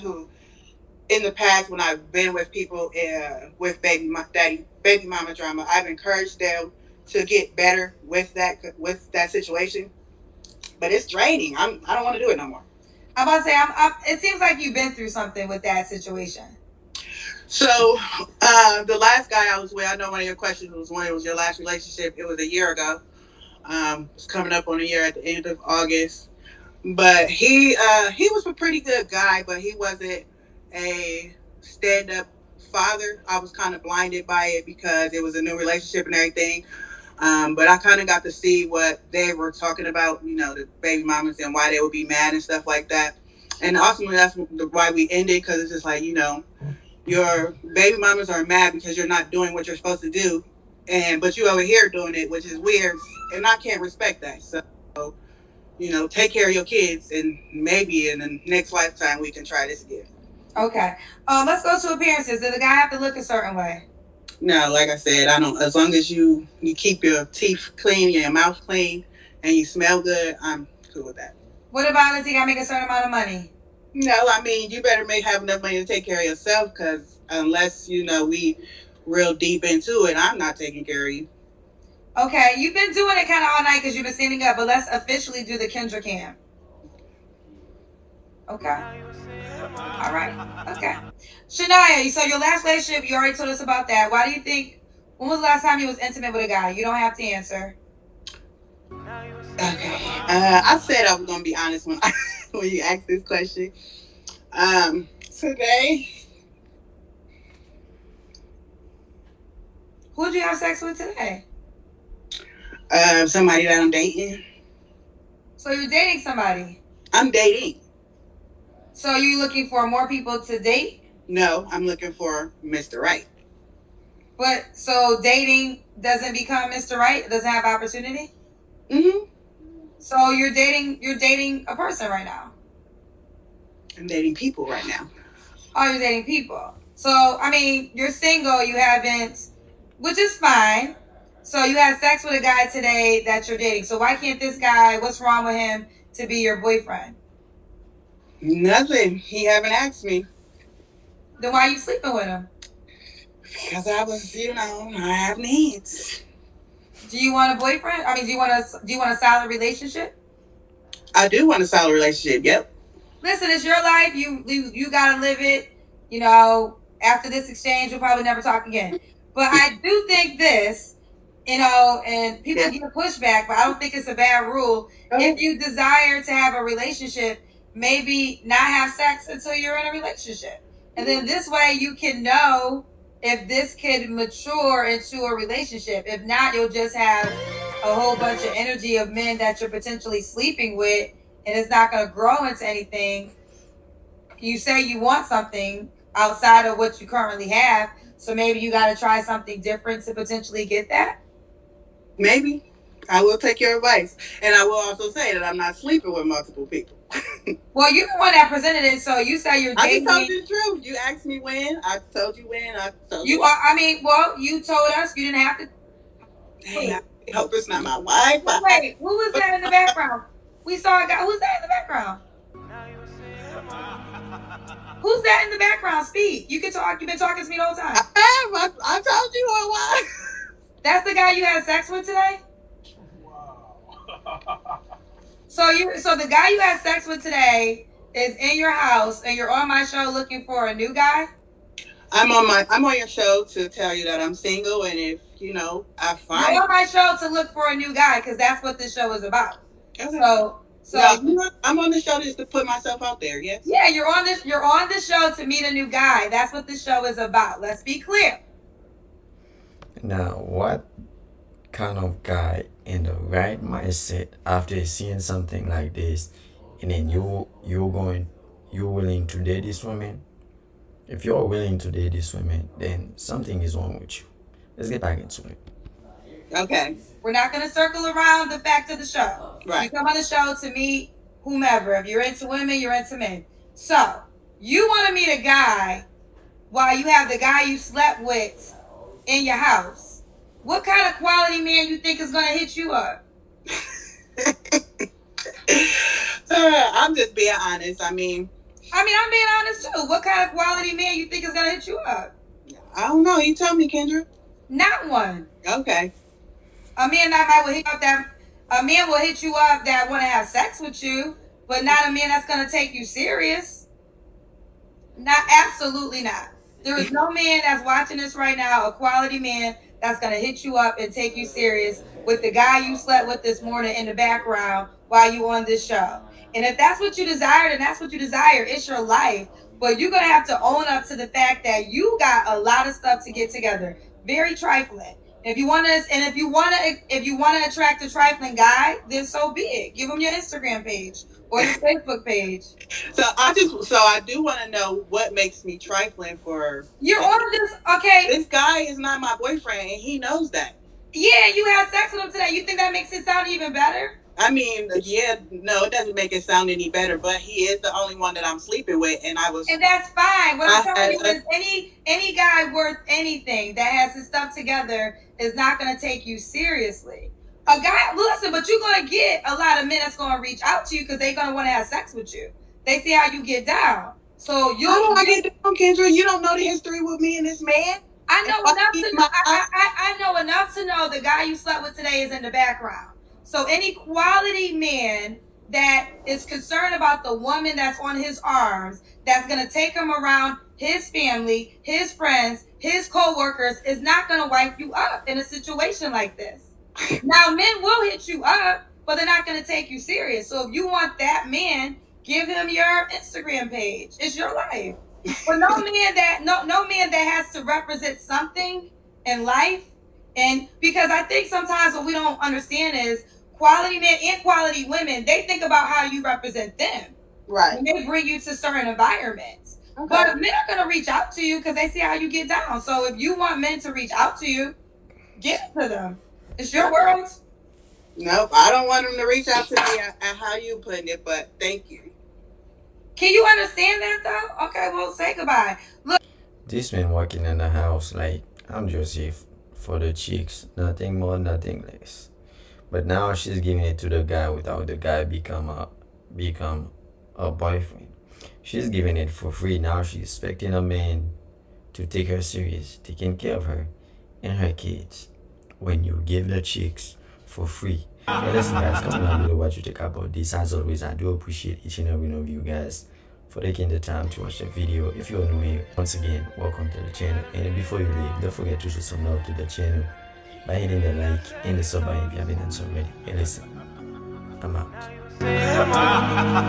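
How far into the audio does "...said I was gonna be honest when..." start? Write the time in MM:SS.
01:40.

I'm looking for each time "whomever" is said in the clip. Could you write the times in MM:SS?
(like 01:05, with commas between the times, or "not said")
04:41.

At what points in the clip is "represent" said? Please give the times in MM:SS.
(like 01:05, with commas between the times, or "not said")
06:47, 06:56.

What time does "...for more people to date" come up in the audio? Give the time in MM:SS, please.
01:59.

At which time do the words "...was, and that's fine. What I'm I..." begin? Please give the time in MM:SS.
05:59.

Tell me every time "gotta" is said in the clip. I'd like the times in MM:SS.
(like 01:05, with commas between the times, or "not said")
01:12, 02:44.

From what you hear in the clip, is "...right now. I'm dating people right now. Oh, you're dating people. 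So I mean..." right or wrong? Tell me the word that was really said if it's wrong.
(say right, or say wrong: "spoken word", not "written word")
right.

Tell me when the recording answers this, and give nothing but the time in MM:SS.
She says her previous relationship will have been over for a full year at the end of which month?
00:25.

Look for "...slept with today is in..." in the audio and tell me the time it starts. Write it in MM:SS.
06:21.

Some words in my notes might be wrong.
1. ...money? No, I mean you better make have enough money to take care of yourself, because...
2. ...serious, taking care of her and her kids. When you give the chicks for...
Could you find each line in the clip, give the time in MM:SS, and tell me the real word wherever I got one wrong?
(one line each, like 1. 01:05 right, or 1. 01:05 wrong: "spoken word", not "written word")
1. 01:13 right
2. 07:32 right.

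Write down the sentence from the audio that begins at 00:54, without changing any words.
So, you know, take care of your kids and maybe in the next lifetime we can try this again.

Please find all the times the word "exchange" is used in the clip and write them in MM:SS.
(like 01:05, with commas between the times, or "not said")
02:47.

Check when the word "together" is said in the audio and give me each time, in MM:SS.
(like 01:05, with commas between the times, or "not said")
05:33, 06:04.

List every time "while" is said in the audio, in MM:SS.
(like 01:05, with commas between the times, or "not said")
04:46, 05:25.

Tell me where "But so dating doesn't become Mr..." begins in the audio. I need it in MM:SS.
02:04.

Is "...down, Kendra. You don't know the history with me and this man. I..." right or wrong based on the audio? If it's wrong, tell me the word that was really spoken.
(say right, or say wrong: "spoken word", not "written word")
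right.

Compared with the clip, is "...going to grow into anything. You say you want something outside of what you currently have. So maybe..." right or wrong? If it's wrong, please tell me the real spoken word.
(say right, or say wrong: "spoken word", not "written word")
right.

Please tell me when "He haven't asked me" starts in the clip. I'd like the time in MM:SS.
02:29.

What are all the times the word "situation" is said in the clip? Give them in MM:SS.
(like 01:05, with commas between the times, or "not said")
00:09, 00:15, 06:35.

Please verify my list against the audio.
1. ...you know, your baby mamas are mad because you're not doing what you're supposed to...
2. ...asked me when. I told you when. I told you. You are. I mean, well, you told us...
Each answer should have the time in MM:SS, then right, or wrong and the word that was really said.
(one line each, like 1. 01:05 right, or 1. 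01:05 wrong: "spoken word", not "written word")
1. 00:46 right
2. 03:31 right.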